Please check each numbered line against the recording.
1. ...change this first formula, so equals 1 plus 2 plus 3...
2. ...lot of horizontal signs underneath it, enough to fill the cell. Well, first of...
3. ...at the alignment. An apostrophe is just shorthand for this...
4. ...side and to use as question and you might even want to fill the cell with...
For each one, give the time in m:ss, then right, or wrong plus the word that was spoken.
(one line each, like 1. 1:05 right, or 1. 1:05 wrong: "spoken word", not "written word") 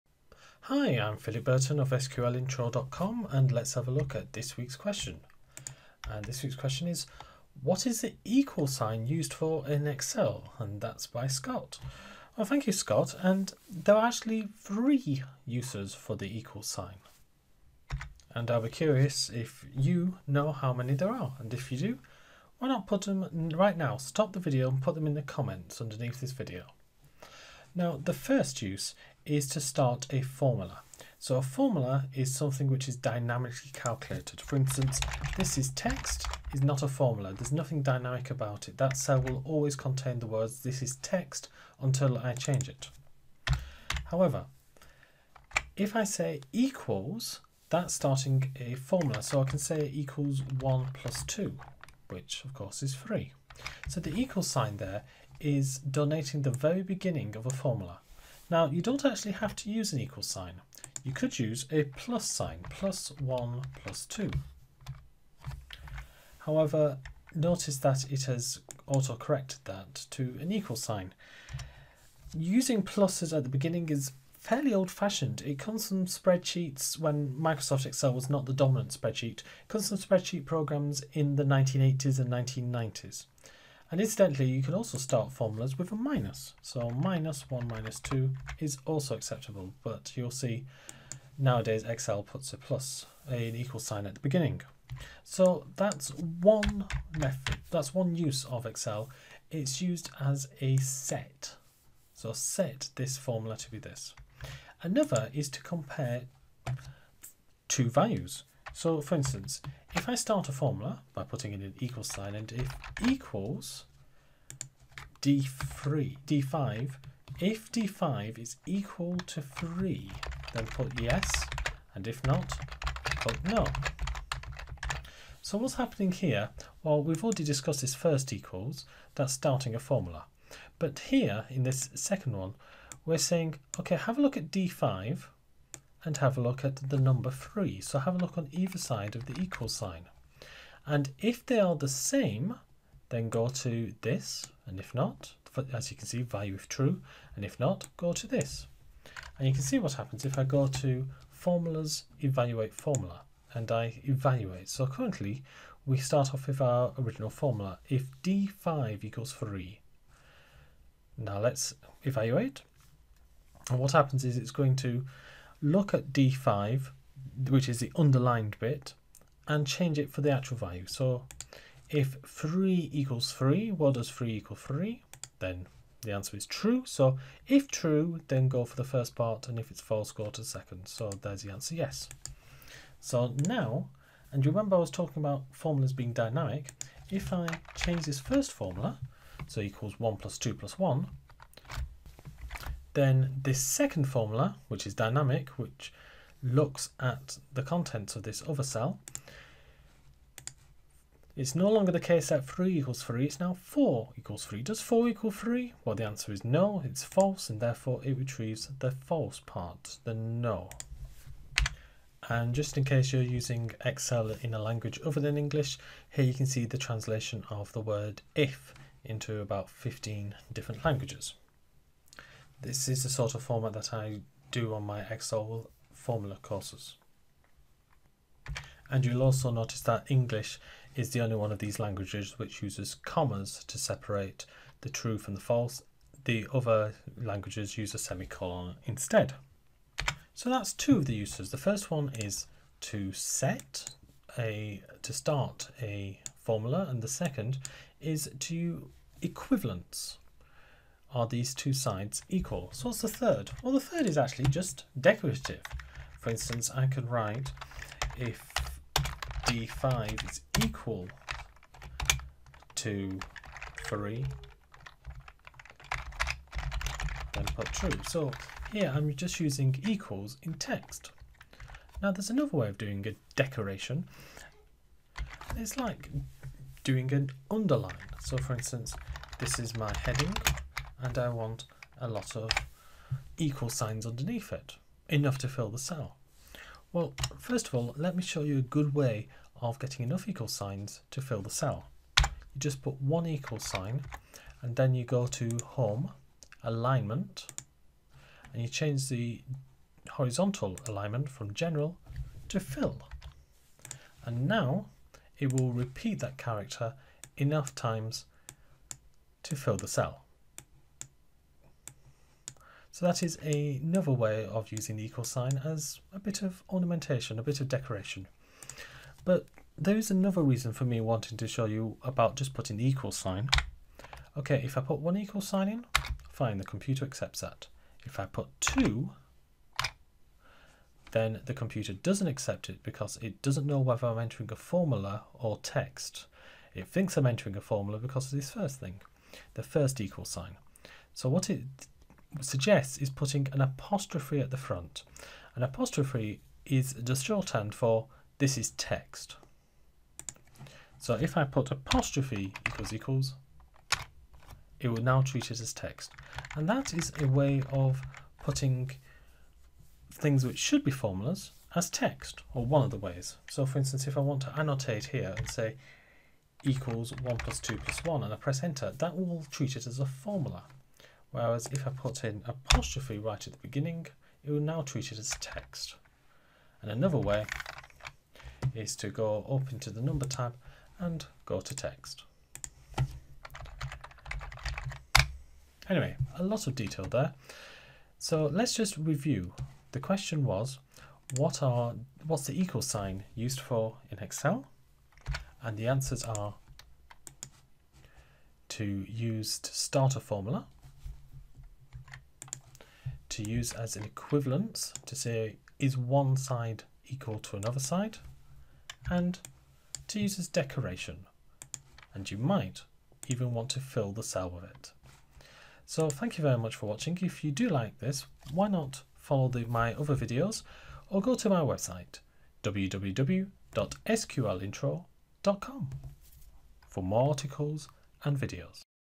1. 3:07 wrong: "1", not "3"
2. 4:42 wrong: "equal", not "horizontal"
3. 5:44 wrong: "front", not "alignment"
4. 6:47 wrong: "decoration", not "question".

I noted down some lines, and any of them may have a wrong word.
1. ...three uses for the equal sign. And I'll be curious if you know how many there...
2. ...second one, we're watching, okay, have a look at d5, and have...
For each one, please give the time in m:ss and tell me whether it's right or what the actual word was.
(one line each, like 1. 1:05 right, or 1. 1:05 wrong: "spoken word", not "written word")
1. 0:14 right
2. 2:11 wrong: "saying", not "watching".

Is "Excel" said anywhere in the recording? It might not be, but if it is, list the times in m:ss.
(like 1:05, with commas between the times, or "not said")
0:09, 1:17, 1:31, 1:38, 3:33, 3:45, 6:34.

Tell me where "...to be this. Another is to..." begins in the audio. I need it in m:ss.
1:43.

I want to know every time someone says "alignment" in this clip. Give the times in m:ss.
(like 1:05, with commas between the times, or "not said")
4:56, 5:00.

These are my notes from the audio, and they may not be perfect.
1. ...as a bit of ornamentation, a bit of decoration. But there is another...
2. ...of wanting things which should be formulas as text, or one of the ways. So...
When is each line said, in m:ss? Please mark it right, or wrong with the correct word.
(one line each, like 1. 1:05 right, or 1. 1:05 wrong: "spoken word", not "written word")
1. 5:15 right
2. 5:57 wrong: "putting", not "wanting".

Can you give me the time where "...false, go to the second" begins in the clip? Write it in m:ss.
2:59.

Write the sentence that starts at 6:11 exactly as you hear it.
Whereas if I put in apostrophe right at the beginning, it will now treat it as text.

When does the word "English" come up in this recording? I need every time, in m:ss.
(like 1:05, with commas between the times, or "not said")
3:35, 3:50.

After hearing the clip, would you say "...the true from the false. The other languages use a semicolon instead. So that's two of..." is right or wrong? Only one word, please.
right.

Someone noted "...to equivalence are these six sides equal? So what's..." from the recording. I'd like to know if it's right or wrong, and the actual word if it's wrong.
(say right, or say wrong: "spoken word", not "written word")
wrong: "two", not "six".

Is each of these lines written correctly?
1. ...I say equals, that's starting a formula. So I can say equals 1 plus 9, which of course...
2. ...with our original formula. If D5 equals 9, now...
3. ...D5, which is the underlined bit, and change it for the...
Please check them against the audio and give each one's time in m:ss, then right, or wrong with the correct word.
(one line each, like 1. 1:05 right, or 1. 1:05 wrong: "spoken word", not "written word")
1. 0:45 wrong: "2", not "9"
2. 2:36 wrong: "3", not "9"
3. 2:46 right.